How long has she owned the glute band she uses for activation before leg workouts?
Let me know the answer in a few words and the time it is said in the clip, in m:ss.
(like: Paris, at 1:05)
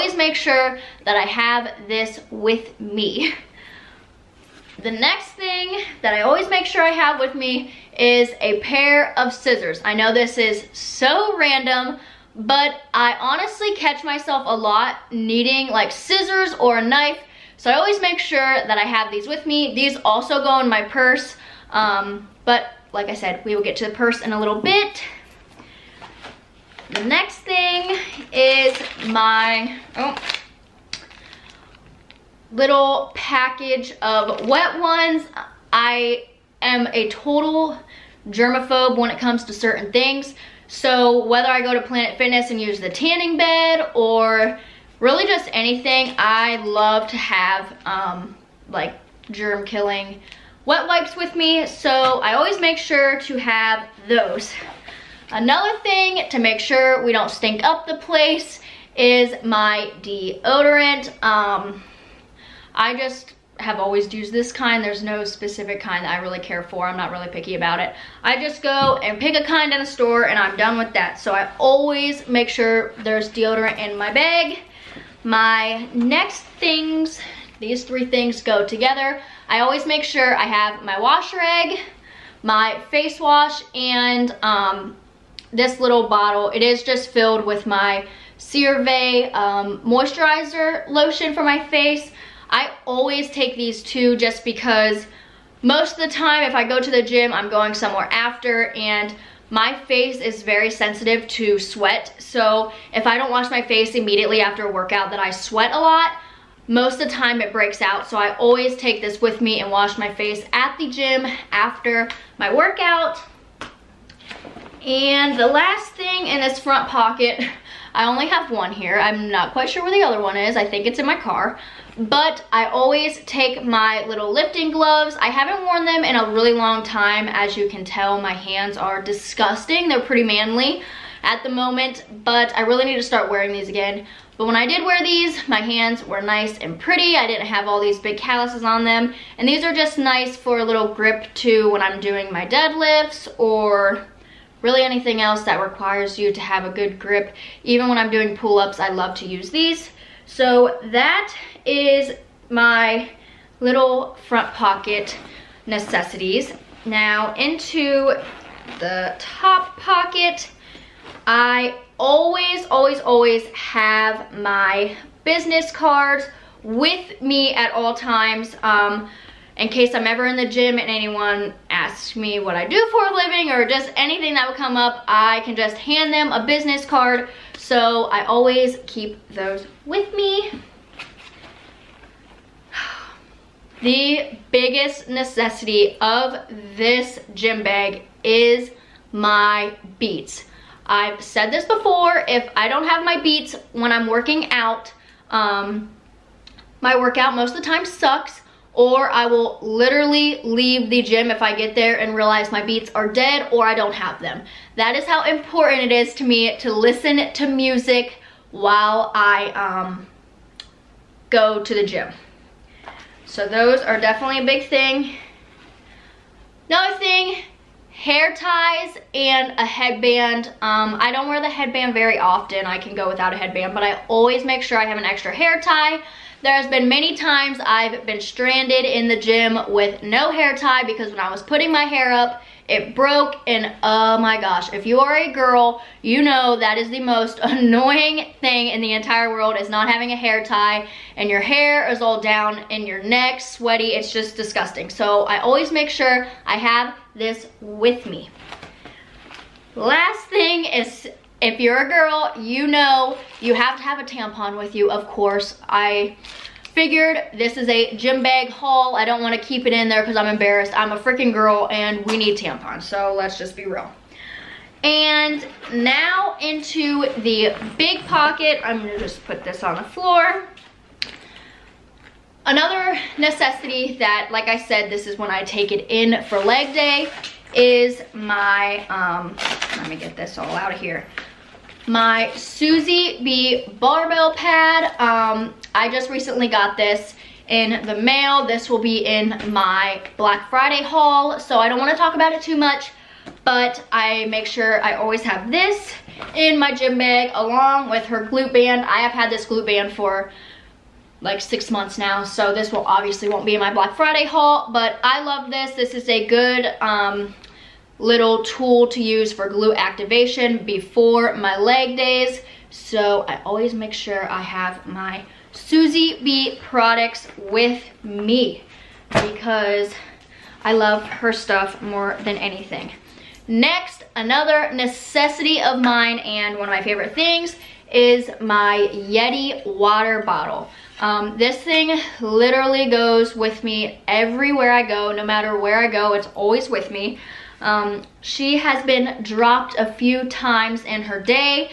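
6 months, at 5:01.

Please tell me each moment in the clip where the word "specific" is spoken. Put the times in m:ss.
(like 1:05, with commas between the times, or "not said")
1:05.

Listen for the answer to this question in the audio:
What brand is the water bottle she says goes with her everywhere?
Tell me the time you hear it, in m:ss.
5:28.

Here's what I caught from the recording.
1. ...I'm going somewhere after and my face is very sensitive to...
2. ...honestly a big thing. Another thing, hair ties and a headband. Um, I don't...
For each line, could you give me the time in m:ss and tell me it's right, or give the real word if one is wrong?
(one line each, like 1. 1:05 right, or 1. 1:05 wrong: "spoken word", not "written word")
1. 1:37 right
2. 3:33 wrong: "definitely", not "honestly".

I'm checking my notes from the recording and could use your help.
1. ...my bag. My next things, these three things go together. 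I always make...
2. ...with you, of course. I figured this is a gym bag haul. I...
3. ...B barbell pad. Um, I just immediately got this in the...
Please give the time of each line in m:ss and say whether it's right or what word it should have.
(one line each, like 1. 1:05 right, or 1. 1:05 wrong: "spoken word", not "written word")
1. 1:13 right
2. 4:14 right
3. 4:43 wrong: "recently", not "immediately".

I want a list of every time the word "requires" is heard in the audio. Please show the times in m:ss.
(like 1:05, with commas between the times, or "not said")
2:25.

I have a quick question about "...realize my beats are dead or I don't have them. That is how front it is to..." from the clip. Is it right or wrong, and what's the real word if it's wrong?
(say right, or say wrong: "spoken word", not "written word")
wrong: "important", not "front".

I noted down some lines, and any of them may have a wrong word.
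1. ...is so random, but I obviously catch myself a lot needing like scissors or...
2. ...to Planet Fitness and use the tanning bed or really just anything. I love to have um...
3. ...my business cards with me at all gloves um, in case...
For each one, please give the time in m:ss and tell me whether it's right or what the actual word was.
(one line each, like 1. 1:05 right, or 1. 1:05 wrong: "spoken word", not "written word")
1. 0:10 wrong: "honestly", not "obviously"
2. 0:41 right
3. 2:44 wrong: "times", not "gloves".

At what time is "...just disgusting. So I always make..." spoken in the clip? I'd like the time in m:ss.
4:04.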